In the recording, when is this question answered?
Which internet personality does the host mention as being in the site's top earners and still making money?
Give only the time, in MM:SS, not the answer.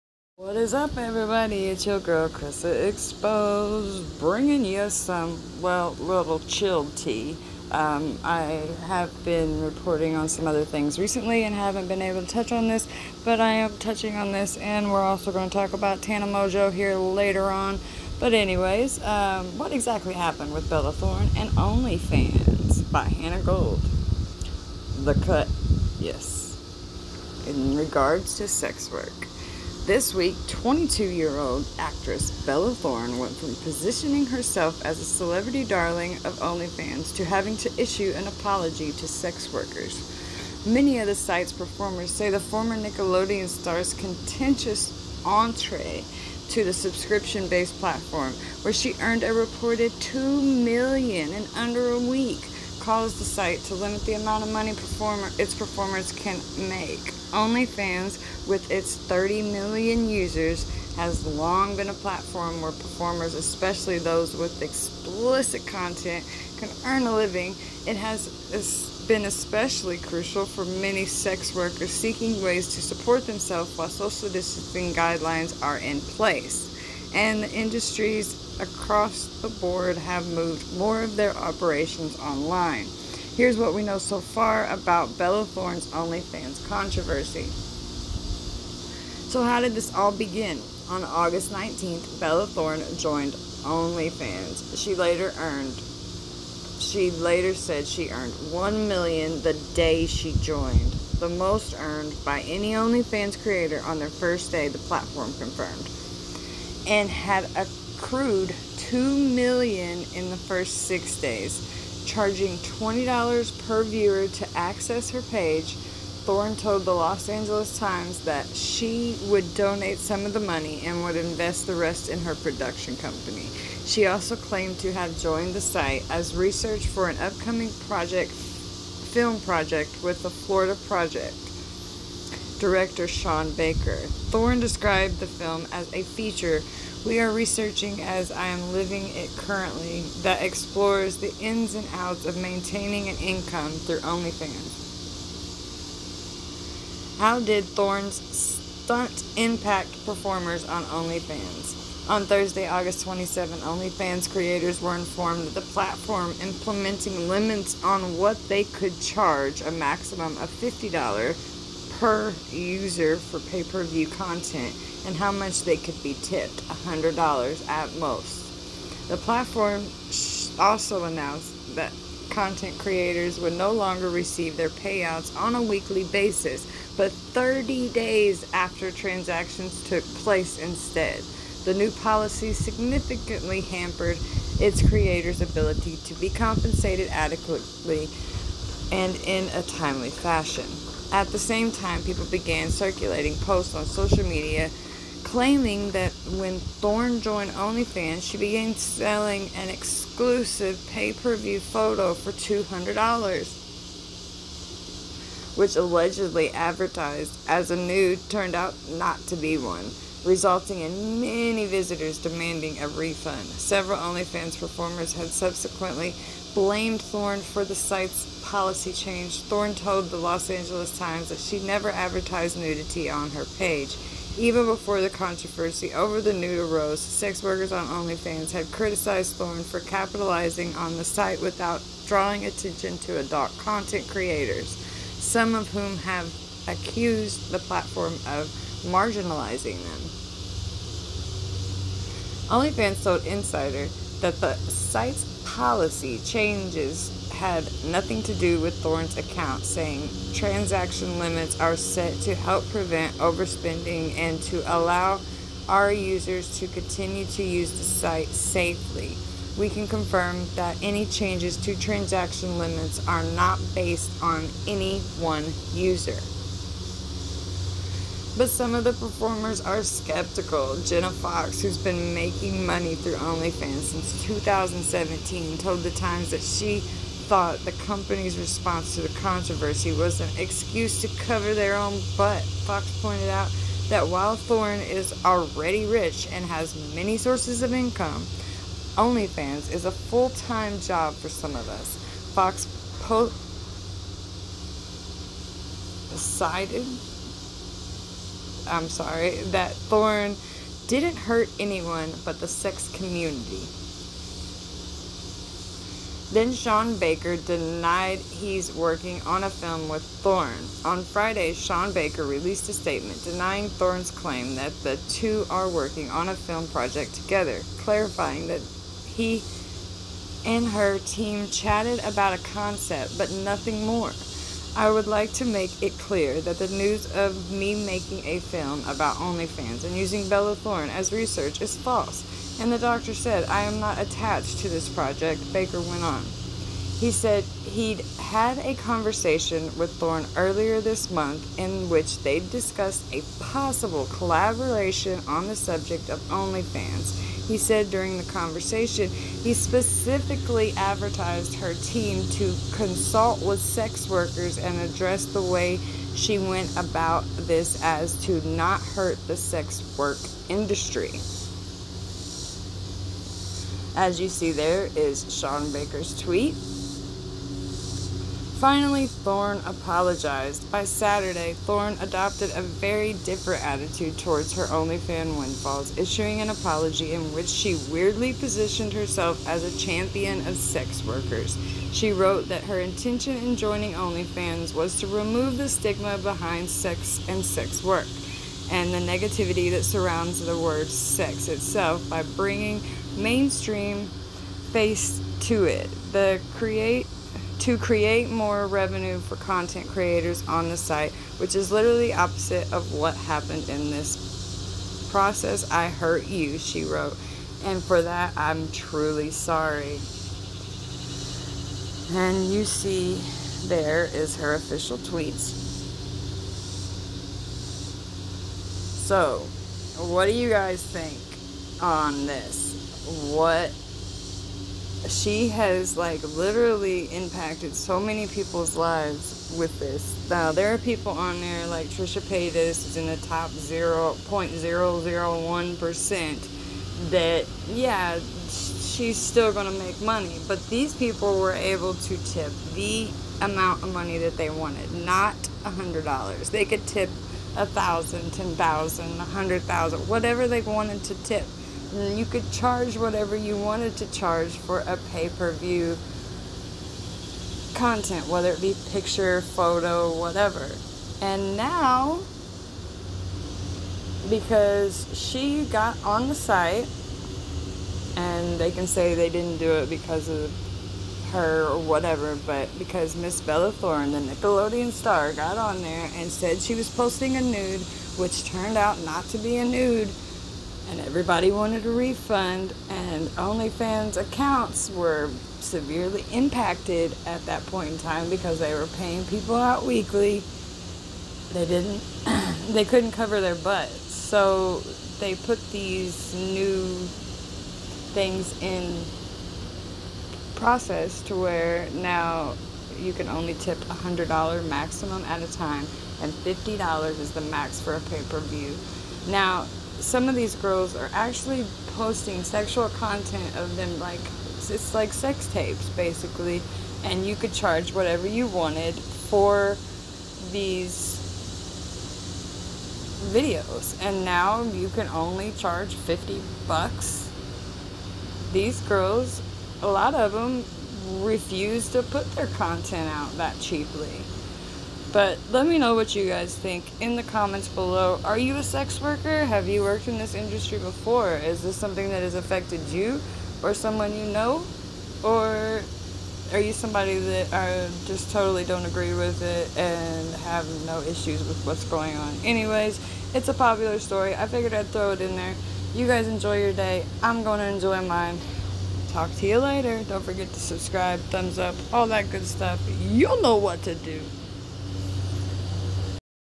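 07:11.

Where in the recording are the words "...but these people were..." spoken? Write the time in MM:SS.
07:20.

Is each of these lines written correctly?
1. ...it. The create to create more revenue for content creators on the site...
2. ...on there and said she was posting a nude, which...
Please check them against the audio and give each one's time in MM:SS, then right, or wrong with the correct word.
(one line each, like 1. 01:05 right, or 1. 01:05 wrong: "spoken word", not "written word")
1. 06:35 right
2. 07:55 right.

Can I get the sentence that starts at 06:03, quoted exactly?
As you see, there is Sean Baker's tweet.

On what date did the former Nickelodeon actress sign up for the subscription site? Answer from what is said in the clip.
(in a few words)
August 19th.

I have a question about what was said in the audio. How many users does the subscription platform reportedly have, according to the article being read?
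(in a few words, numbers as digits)
30 million.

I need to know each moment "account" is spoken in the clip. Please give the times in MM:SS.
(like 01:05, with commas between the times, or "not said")
04:09, 08:04.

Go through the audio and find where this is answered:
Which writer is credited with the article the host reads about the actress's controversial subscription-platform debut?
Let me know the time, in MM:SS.
00:23.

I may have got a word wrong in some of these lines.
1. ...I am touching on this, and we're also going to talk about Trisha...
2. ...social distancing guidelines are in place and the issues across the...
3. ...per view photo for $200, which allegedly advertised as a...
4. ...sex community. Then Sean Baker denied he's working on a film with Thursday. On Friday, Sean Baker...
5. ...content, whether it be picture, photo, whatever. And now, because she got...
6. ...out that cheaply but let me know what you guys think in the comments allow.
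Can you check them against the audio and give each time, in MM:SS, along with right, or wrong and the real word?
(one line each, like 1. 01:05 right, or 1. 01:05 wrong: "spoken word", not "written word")
1. 00:13 wrong: "Tana", not "Trisha"
2. 01:13 wrong: "industries", not "issues"
3. 03:21 right
4. 05:02 wrong: "Thorne", not "Thursday"
5. 07:37 right
6. 08:53 wrong: "below", not "allow".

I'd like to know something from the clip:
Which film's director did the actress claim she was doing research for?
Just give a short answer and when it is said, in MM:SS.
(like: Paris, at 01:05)
The Florida Project, at 02:10.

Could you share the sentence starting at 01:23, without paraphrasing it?
Here's what we know so far about Bella Thorne's OnlyFans controversy.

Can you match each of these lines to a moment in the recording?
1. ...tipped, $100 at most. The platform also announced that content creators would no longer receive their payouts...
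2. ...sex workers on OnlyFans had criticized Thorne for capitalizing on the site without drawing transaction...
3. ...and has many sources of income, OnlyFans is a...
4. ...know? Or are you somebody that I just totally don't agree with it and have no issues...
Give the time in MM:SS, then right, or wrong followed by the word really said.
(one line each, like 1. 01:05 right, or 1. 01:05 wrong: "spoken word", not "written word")
1. 02:46 right
2. 03:47 wrong: "attention", not "transaction"
3. 04:46 right
4. 09:04 right.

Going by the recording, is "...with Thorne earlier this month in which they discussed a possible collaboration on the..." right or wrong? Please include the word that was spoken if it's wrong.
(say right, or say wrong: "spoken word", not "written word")
right.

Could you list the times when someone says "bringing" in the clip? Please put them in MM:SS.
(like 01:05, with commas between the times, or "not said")
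00:04, 06:32.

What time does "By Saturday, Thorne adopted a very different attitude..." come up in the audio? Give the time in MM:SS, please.
06:10.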